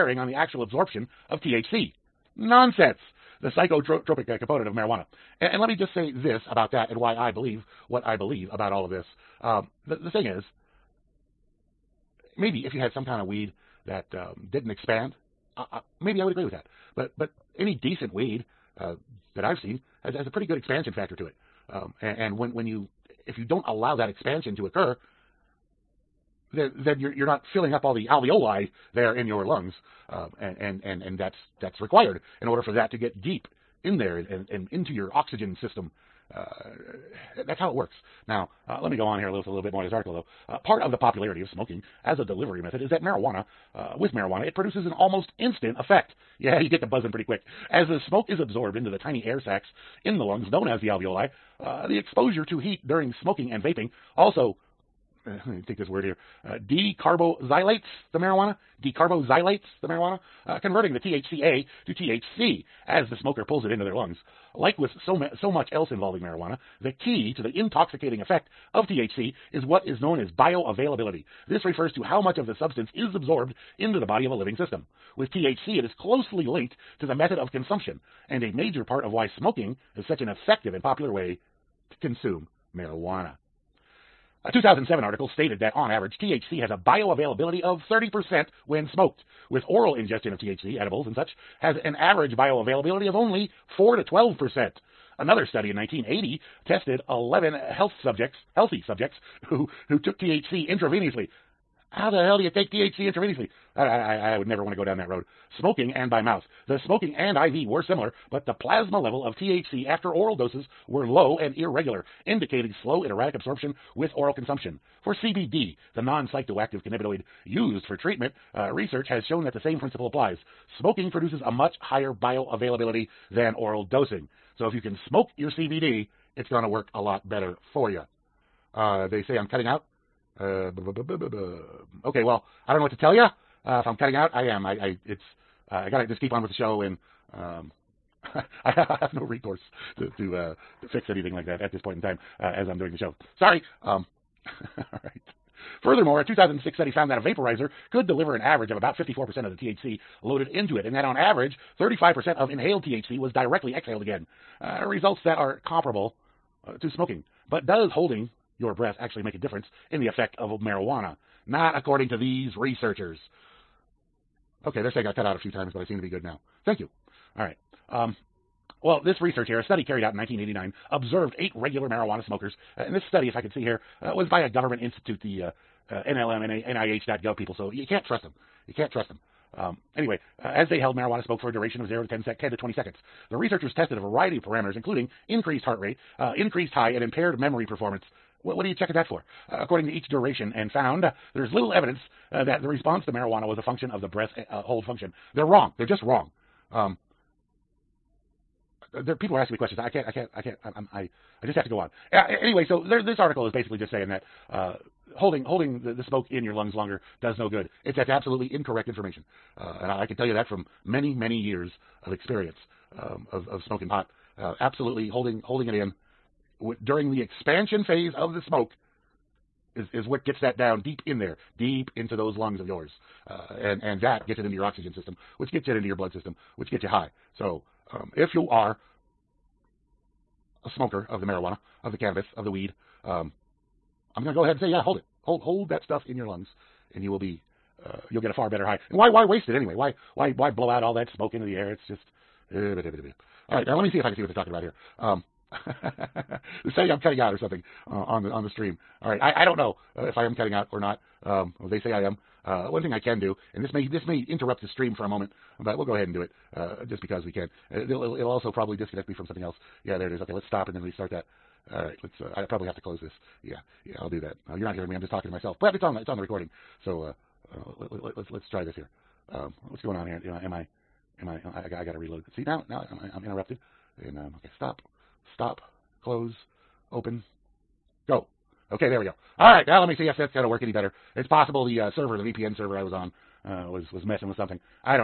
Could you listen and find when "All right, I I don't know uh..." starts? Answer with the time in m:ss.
4:09.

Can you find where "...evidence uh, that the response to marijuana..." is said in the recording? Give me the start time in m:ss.
3:11.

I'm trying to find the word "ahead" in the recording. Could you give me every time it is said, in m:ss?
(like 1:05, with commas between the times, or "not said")
3:54, 4:15.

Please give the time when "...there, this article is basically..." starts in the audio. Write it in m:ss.
3:22.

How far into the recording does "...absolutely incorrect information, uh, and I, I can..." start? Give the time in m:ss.
3:28.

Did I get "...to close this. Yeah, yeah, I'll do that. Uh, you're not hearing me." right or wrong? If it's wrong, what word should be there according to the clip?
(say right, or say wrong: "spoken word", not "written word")
right.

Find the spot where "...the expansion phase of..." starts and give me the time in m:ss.
3:37.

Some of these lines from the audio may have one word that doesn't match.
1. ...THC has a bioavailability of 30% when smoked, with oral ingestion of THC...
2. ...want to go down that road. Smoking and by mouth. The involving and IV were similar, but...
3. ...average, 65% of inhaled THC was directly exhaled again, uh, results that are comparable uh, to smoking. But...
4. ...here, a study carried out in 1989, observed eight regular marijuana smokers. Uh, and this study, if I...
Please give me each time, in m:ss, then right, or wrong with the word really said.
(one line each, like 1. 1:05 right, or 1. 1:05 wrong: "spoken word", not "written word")
1. 1:26 right
2. 1:44 wrong: "smoking", not "involving"
3. 2:31 wrong: "35", not "65"
4. 2:49 right.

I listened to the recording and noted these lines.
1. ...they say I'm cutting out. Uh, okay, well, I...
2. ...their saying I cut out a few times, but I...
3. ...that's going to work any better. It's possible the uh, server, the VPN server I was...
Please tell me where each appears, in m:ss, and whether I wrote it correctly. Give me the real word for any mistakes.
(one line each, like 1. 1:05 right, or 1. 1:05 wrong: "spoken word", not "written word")
1. 2:09 right
2. 2:44 right
3. 4:40 right.